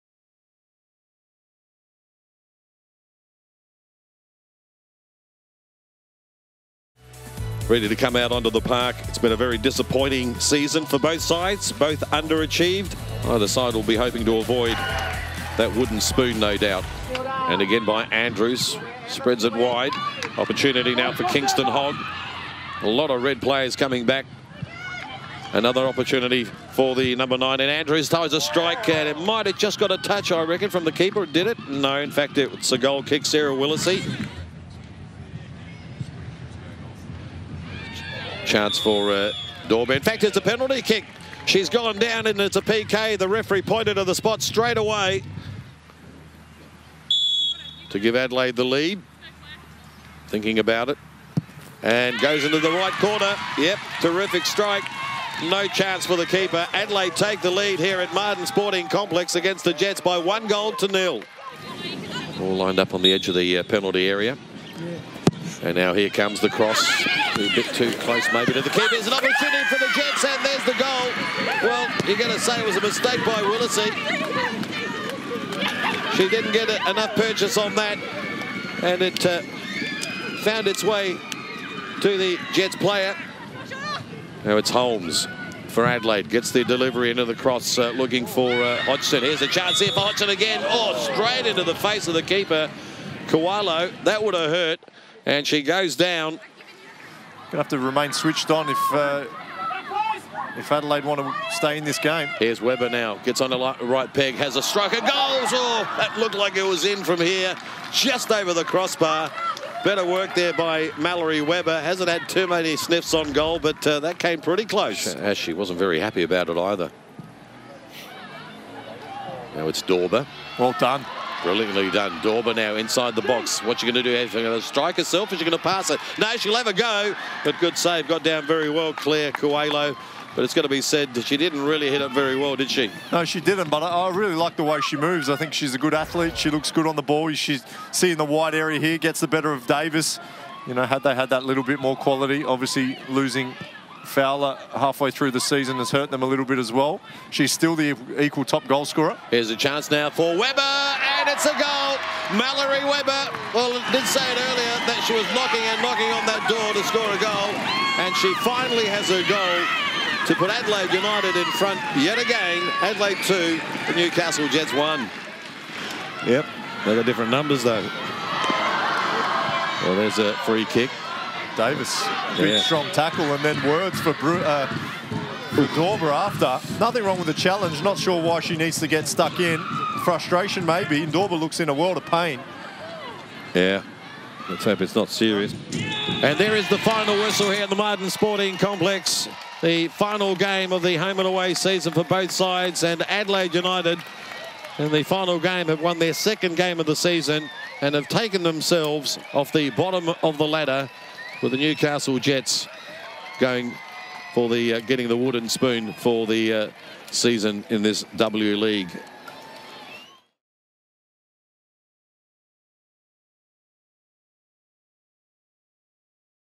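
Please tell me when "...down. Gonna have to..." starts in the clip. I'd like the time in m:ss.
1:35.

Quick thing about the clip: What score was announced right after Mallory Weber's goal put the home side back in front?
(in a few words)
Adelaide 2, Newcastle Jets 1.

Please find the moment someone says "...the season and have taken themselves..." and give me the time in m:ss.
3:16.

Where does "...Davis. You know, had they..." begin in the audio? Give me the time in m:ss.
2:19.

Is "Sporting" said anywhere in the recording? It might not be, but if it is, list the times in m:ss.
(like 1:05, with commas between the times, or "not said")
0:58, 3:08.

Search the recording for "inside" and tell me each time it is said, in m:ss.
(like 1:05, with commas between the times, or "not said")
2:02.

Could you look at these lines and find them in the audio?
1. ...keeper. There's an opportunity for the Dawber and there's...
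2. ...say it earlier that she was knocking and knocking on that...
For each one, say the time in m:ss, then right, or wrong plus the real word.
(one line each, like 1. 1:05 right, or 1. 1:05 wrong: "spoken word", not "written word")
1. 1:08 wrong: "Jets", not "Dawber"
2. 2:34 right.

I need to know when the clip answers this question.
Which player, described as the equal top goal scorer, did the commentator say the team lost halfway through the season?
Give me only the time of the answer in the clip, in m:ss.
2:24.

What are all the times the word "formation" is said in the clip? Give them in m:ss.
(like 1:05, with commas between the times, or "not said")
not said.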